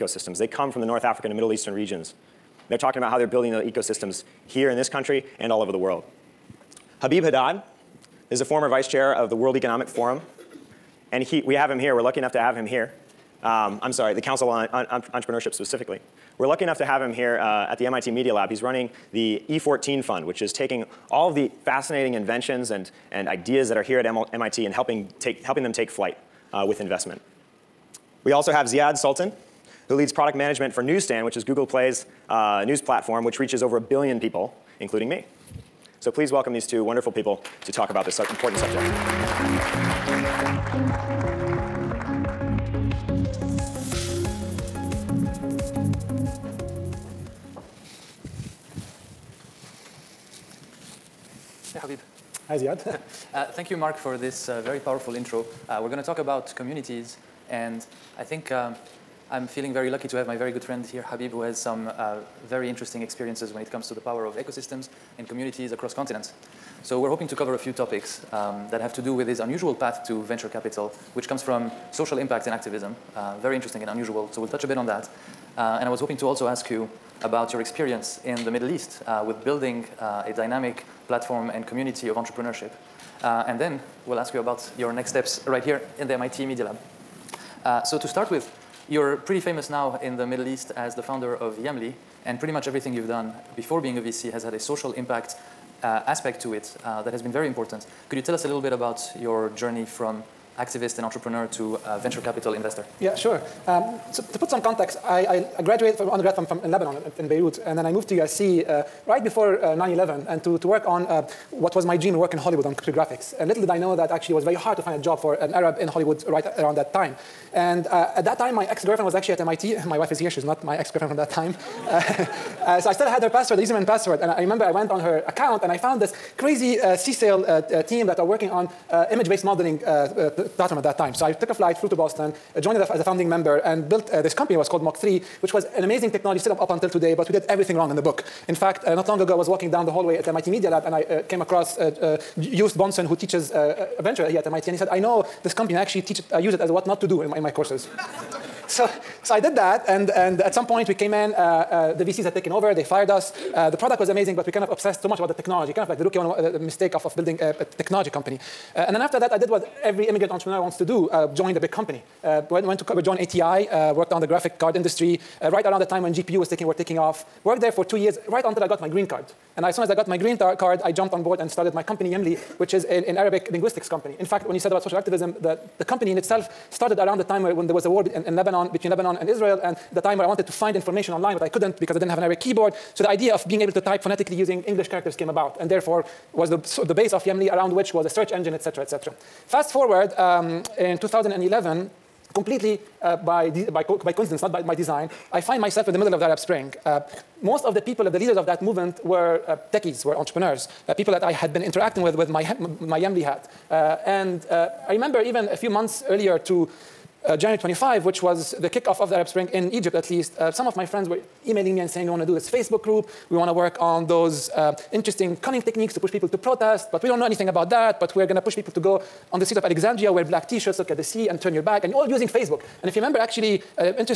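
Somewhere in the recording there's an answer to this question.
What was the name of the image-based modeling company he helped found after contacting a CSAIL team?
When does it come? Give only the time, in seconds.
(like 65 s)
134 s.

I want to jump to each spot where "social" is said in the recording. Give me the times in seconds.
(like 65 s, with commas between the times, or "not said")
71 s, 94 s, 174 s.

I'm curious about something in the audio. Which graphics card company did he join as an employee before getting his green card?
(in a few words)
ATI.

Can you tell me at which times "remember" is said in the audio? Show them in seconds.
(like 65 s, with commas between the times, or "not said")
124 s, 204 s, 222 s.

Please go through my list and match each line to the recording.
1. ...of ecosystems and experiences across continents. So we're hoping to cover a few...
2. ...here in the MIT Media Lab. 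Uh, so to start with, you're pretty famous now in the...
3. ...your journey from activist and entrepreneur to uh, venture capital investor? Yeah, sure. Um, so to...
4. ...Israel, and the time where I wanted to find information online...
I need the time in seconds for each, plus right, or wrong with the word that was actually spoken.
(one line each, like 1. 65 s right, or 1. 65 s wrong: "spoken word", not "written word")
1. 64 s wrong: "communities", not "experiences"
2. 85 s right
3. 99 s right
4. 179 s right.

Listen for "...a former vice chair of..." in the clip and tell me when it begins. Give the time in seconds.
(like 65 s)
8 s.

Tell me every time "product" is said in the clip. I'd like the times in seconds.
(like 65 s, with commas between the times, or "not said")
30 s, 153 s.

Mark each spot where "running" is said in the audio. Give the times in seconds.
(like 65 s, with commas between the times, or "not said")
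18 s.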